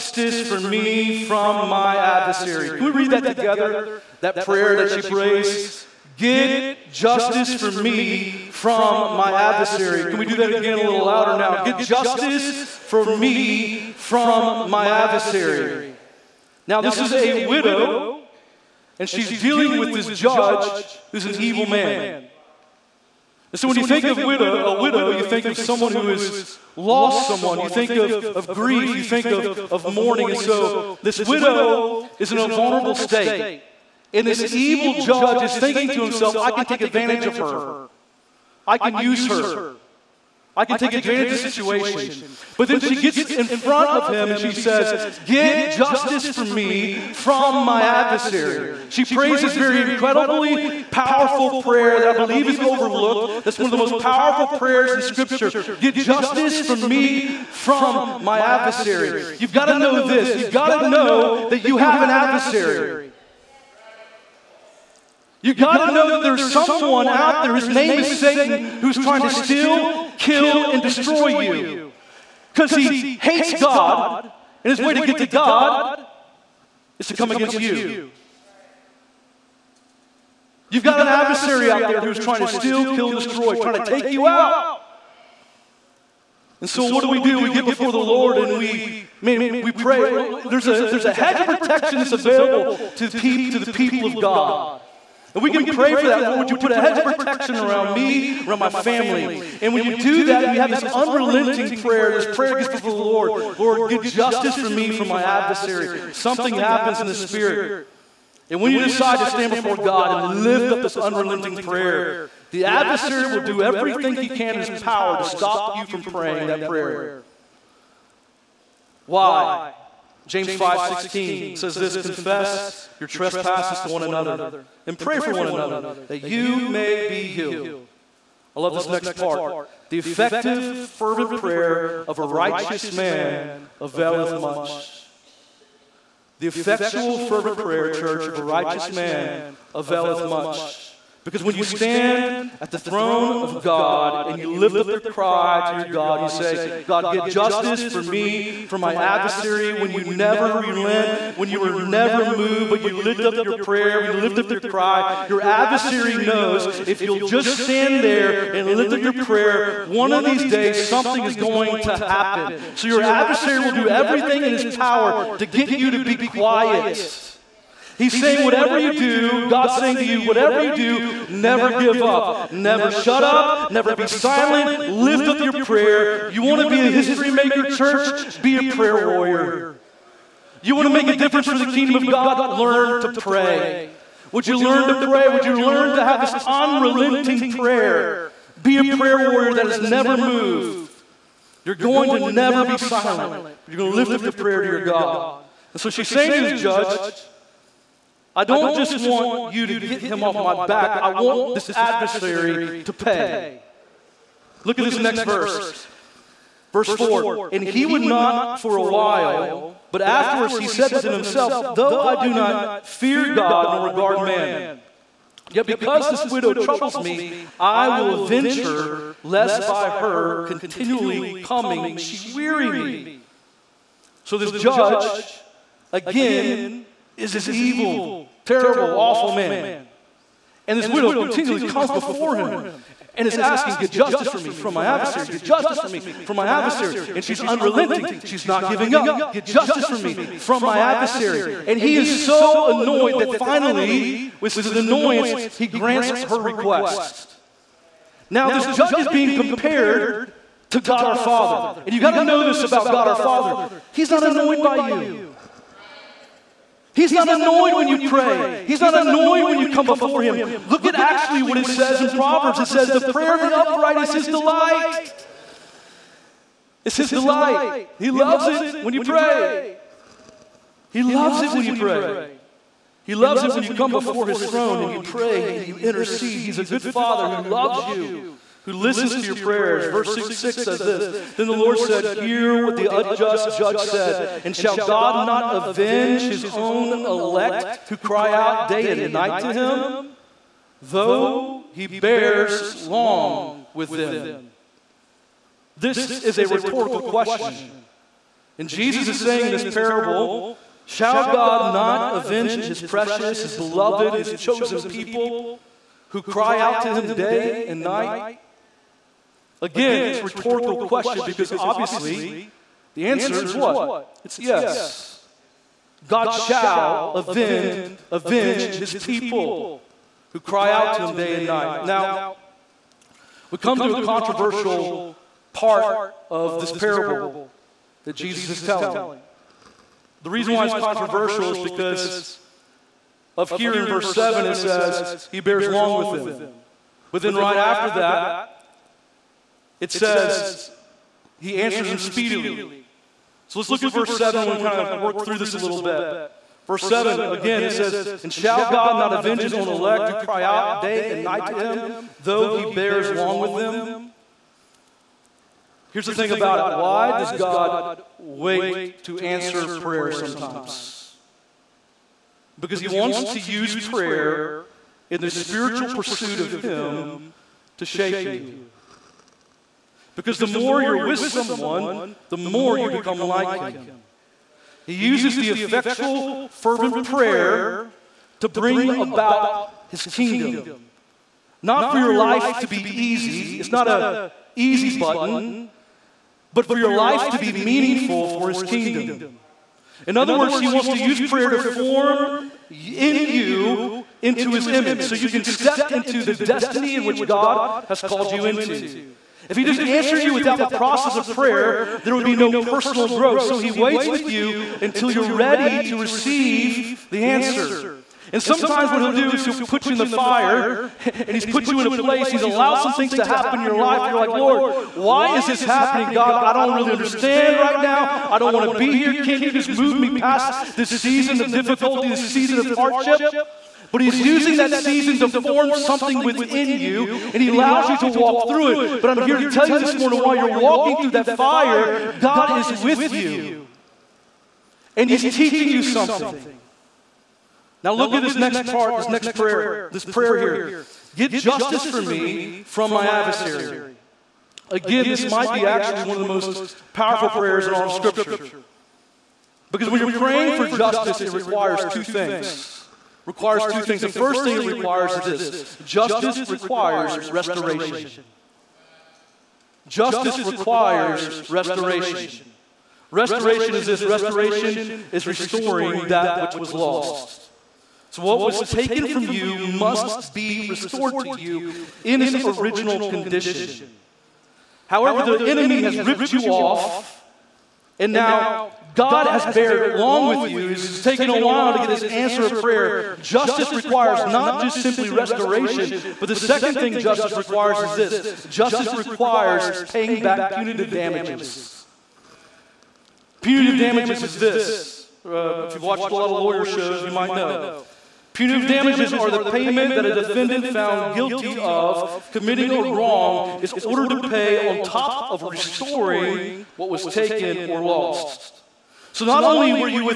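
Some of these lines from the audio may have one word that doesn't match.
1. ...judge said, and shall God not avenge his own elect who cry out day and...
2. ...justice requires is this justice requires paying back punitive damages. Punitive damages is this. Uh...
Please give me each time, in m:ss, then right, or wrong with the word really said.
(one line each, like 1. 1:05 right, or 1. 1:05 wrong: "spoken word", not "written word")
1. 4:43 right
2. 8:06 right.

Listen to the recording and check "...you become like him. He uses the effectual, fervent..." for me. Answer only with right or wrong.
right.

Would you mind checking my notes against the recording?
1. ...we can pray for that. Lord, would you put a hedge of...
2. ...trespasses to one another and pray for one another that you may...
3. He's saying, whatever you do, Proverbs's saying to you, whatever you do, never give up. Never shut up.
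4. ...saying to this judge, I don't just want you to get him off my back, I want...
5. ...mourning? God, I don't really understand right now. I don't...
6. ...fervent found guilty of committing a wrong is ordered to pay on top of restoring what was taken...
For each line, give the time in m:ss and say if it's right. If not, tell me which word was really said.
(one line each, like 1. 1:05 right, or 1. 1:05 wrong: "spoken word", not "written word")
1. 1:35 right
2. 2:03 right
3. 2:48 wrong: "God", not "Proverbs"
4. 3:16 right
5. 6:55 wrong: "happening", not "mourning"
6. 8:20 wrong: "defendant", not "fervent".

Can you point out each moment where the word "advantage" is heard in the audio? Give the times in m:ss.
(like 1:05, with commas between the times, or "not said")
0:36, 0:40.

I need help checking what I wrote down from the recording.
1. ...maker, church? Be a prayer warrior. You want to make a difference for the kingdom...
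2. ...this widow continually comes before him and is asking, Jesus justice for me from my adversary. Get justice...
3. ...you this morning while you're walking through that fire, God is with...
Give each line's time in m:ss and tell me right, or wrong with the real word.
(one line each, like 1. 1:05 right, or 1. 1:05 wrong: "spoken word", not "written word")
1. 2:57 right
2. 3:50 wrong: "Get", not "Jesus"
3. 7:09 right.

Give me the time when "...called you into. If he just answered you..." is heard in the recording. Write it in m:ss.
6:38.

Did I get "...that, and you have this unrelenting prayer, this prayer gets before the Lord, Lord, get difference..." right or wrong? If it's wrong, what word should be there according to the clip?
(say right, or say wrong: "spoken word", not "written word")
wrong: "justice", not "difference".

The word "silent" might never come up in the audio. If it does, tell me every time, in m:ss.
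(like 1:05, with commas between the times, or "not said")
2:54, 3:12.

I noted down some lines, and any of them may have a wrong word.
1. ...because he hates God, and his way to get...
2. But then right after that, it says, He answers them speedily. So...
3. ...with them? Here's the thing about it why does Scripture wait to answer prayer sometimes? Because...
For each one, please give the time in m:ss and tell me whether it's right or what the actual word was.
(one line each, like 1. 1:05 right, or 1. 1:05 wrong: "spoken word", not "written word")
1. 1:12 right
2. 5:37 right
3. 5:53 wrong: "God", not "Scripture".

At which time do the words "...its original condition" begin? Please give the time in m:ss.
7:52.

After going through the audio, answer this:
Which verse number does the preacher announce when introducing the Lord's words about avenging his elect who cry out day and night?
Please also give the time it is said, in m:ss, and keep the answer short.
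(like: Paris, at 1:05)
Verse 6, at 4:39.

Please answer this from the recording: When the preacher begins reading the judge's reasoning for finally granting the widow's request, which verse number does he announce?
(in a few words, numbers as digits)
Verse 4.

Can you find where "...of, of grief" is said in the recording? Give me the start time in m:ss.
0:27.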